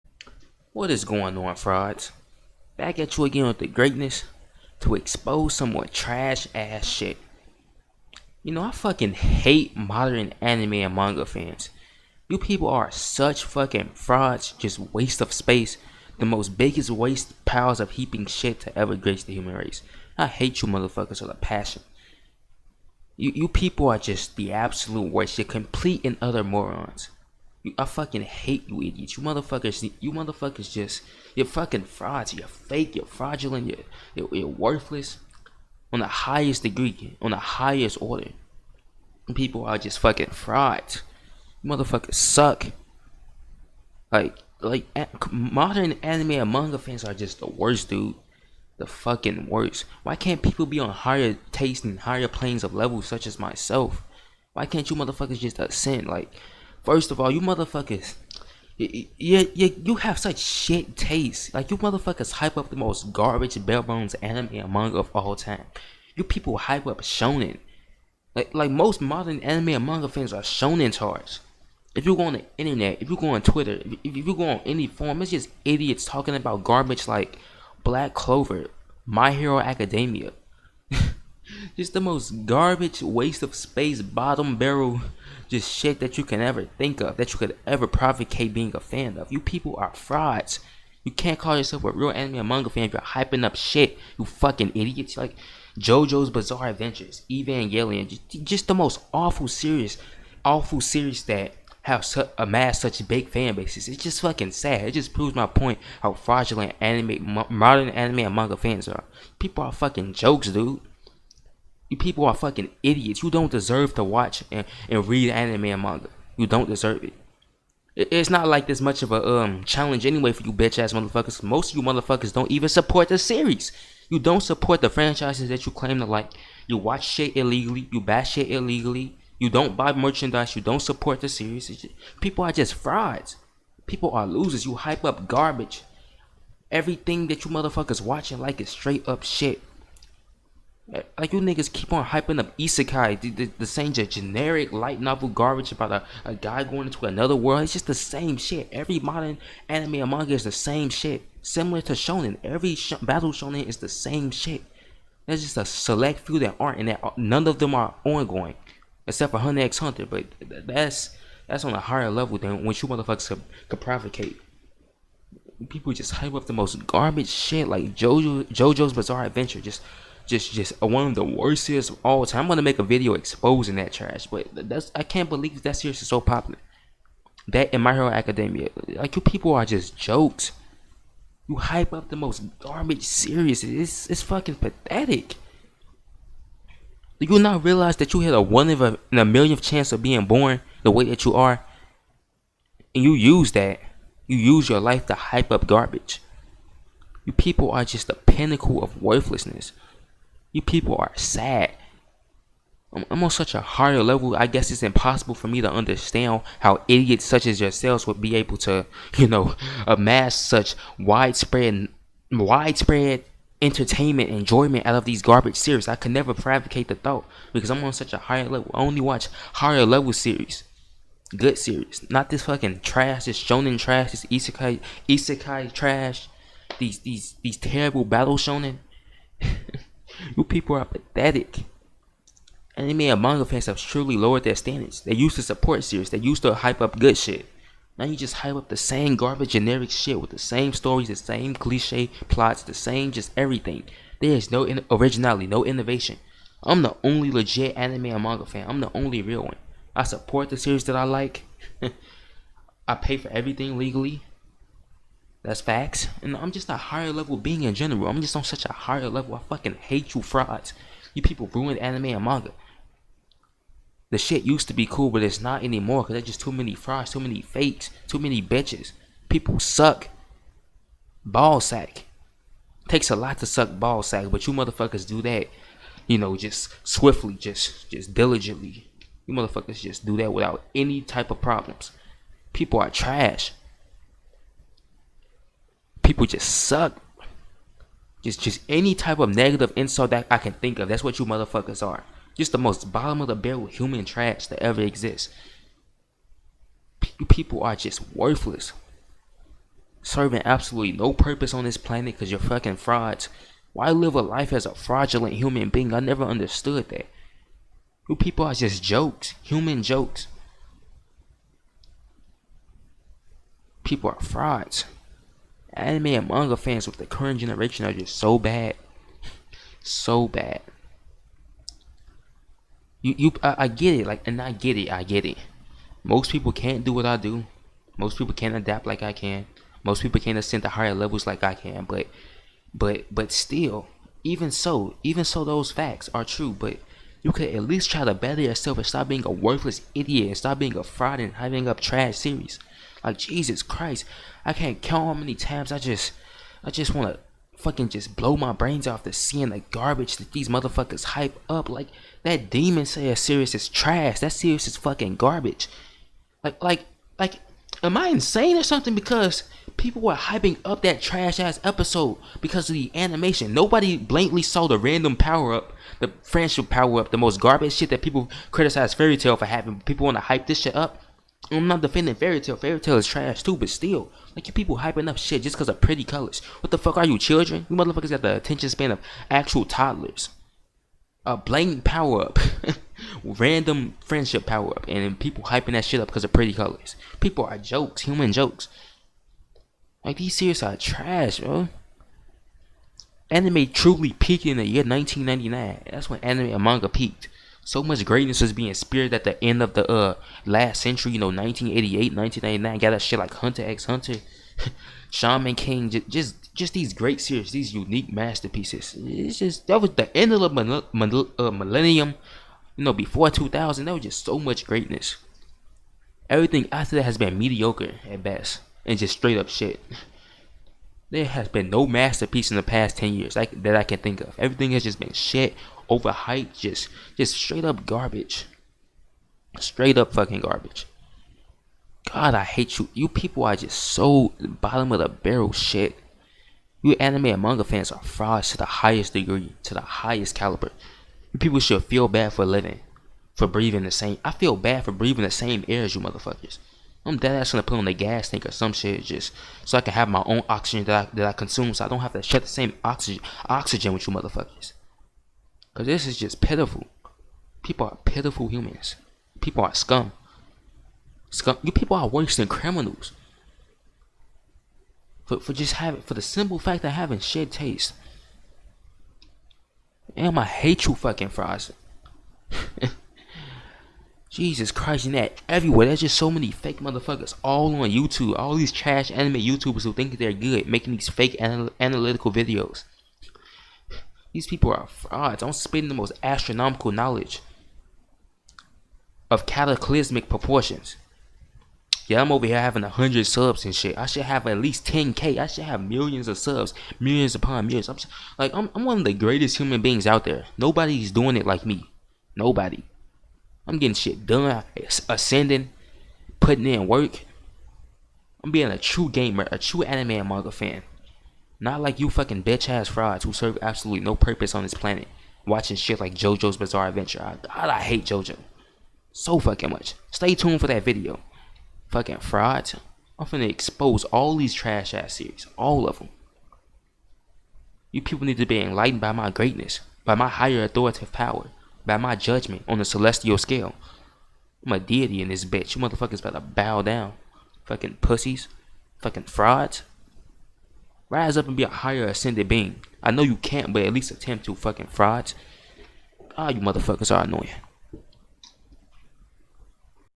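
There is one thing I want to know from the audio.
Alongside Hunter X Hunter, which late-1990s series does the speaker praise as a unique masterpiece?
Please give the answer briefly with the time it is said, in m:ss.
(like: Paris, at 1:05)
Shaman King, at 6:45.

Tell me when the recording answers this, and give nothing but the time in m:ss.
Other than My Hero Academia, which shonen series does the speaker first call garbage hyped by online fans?
1:17.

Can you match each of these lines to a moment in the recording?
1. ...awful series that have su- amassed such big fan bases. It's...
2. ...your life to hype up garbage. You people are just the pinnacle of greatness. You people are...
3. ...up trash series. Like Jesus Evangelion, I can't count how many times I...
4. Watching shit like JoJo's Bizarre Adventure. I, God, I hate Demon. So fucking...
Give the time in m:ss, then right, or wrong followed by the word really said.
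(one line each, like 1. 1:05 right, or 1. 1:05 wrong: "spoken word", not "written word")
1. 1:40 right
2. 3:14 wrong: "worthlessness", not "greatness"
3. 5:41 wrong: "Christ", not "Evangelion"
4. 8:35 wrong: "JoJo", not "Demon".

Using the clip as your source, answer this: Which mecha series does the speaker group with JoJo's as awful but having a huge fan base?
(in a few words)
Evangelion.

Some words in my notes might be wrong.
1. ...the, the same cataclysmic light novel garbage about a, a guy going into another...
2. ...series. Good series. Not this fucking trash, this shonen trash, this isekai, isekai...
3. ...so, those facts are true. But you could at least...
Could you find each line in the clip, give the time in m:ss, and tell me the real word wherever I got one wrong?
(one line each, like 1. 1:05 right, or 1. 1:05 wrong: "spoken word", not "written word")
1. 2:23 wrong: "generic", not "cataclysmic"
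2. 3:40 right
3. 5:35 right.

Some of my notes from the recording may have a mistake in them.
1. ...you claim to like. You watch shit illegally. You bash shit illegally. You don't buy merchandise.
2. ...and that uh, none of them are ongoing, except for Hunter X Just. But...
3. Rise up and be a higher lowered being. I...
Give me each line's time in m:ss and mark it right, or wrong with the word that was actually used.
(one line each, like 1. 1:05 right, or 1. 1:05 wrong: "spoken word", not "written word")
1. 2:05 right
2. 2:36 wrong: "Hunter", not "Just"
3. 9:01 wrong: "ascended", not "lowered".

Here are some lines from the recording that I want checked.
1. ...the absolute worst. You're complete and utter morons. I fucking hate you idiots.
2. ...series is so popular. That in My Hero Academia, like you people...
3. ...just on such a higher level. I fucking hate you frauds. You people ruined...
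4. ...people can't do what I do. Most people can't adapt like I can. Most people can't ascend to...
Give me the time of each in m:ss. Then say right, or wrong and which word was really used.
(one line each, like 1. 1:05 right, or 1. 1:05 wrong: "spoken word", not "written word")
1. 0:24 right
2. 2:55 right
3. 4:18 right
4. 5:26 right.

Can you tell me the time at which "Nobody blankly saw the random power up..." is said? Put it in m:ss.
6:03.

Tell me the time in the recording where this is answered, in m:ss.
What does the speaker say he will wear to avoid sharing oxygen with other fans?
7:27.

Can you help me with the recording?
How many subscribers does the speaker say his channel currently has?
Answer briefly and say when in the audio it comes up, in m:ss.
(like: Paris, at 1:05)
100, at 8:12.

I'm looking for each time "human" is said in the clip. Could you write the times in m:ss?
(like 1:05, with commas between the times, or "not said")
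0:19, 4:53, 5:05, 5:09, 6:28, 7:38, 8:19.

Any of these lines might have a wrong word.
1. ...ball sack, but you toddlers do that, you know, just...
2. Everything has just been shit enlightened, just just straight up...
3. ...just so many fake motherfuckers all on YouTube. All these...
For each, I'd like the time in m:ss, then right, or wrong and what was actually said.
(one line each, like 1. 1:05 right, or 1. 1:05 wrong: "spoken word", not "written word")
1. 4:33 wrong: "motherfuckers", not "toddlers"
2. 7:04 wrong: "overhyped", not "enlightened"
3. 7:56 right.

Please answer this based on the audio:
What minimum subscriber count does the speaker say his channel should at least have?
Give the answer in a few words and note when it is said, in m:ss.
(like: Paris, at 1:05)
10k, at 8:14.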